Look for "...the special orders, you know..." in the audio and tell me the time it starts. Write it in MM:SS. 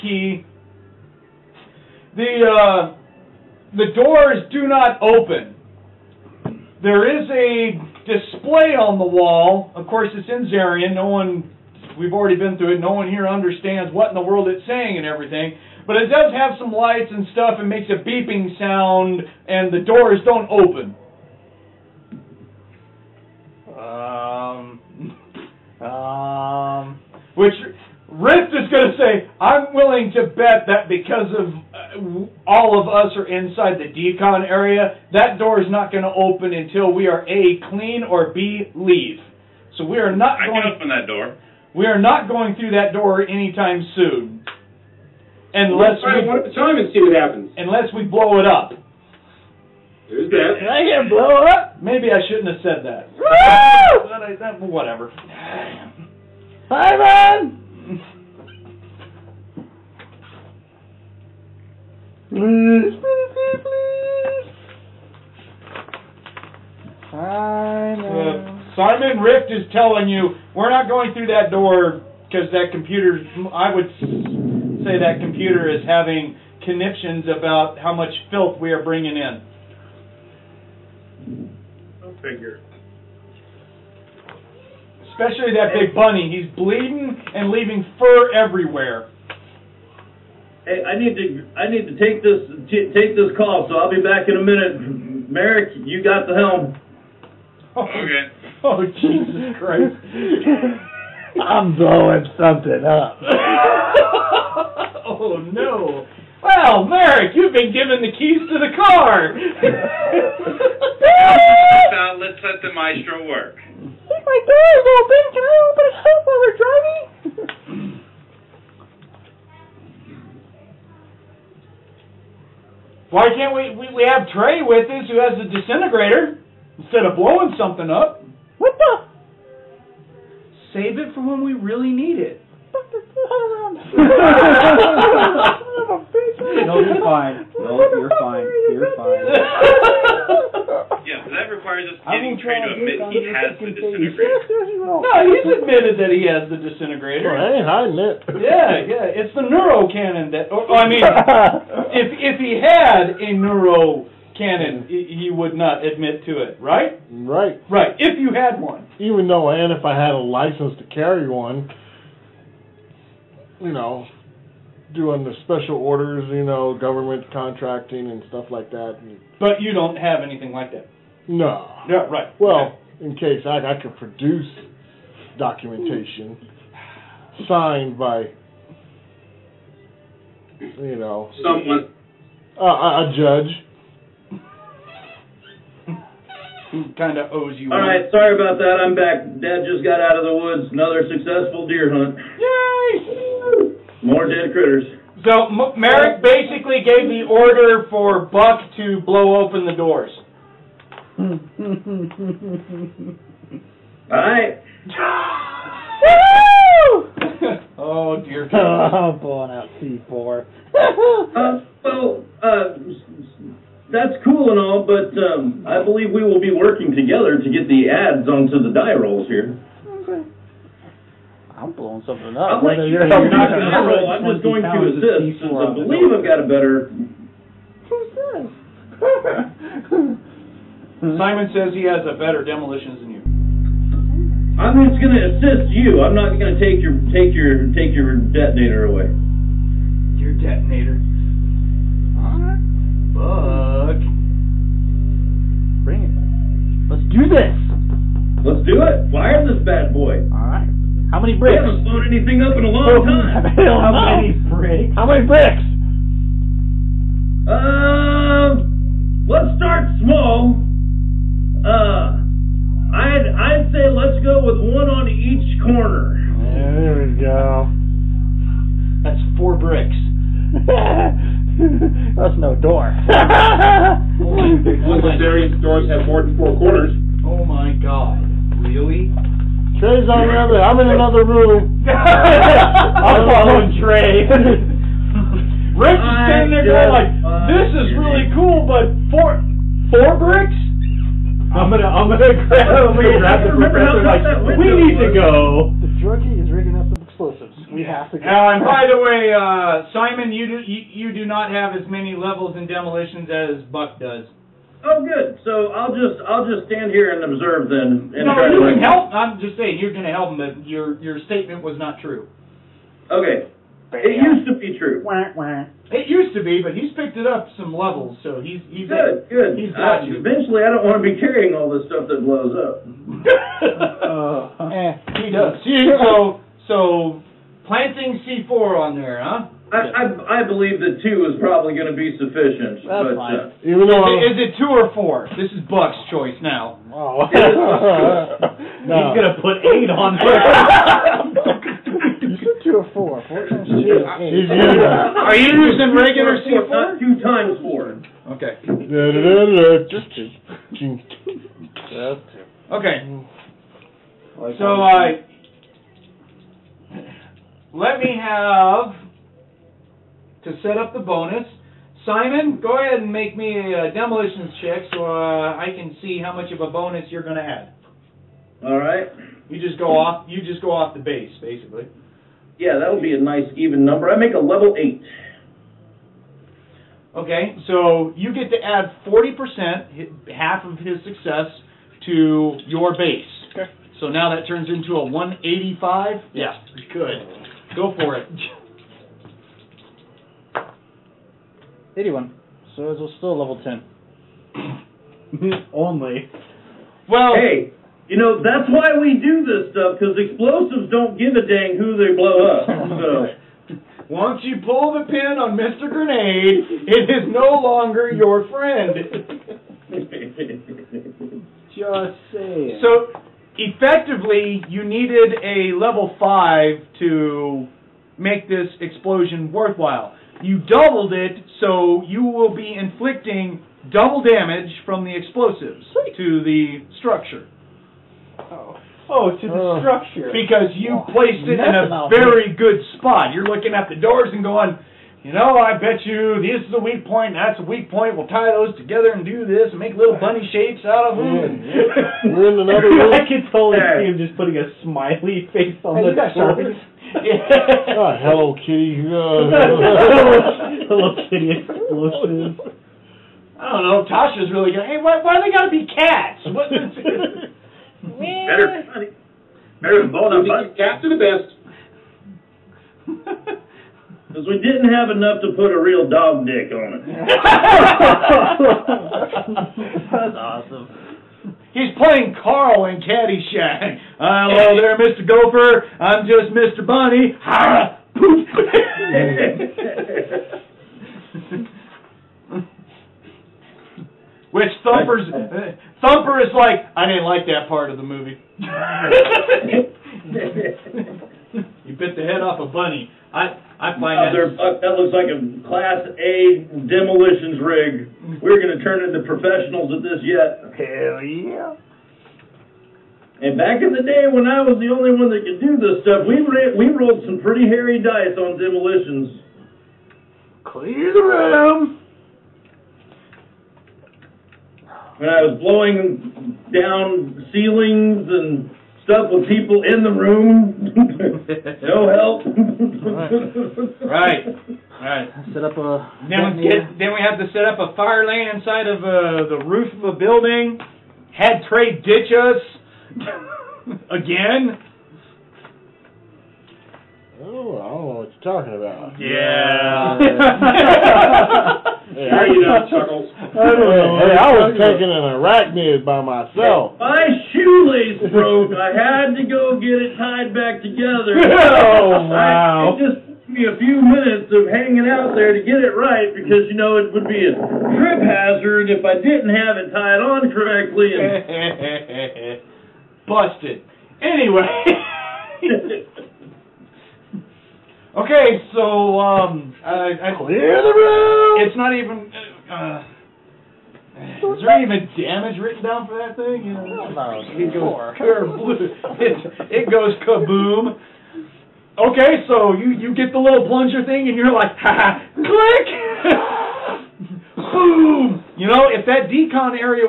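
02:45.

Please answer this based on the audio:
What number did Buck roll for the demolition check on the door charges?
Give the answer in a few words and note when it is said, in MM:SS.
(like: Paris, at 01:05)
81, at 06:31.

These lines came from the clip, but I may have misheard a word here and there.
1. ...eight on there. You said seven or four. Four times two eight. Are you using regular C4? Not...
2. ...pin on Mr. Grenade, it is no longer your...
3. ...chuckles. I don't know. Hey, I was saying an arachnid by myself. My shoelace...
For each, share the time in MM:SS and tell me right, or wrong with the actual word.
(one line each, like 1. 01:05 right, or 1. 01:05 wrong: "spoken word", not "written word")
1. 05:39 wrong: "two", not "seven"
2. 06:45 right
3. 09:02 wrong: "taking", not "saying".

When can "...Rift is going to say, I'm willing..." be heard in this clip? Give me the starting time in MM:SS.
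00:28.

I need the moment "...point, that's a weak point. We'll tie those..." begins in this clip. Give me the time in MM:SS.
07:17.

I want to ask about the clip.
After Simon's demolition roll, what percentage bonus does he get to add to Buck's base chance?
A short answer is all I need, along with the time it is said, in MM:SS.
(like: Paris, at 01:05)
40%, at 06:19.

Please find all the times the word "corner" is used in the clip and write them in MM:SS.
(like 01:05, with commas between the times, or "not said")
04:25, 04:36.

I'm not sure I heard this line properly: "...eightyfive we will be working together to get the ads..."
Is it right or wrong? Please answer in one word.
wrong.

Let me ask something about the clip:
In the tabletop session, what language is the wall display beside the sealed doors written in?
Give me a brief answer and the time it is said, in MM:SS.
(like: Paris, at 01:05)
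Zarian, at 00:10.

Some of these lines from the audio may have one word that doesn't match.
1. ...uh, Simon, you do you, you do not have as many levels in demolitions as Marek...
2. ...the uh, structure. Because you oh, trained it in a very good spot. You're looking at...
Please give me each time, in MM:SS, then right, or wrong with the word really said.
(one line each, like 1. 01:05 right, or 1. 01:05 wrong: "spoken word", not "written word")
1. 04:59 wrong: "Buck", not "Marek"
2. 07:09 wrong: "placed", not "trained".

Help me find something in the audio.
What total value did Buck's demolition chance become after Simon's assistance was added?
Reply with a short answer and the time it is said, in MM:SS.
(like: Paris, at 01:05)
185, at 06:25.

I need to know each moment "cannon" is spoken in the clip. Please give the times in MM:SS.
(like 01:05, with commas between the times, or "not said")
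02:29, 02:34.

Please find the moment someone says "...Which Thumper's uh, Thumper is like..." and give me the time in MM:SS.
08:04.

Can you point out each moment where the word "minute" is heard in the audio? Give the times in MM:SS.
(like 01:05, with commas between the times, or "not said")
01:34, 09:14.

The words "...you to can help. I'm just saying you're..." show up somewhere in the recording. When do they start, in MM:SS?
05:08.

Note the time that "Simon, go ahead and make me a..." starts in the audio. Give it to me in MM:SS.
06:02.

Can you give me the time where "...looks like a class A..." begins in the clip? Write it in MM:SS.
08:14.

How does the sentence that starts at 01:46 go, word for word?
Well, Marek, you've been given the keys to the car.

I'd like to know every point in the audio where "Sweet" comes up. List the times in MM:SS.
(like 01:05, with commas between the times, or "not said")
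07:05.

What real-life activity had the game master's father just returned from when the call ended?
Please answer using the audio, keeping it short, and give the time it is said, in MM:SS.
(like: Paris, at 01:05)
deer hunt, at 03:11.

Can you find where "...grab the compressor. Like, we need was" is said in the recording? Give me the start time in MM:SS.
04:53.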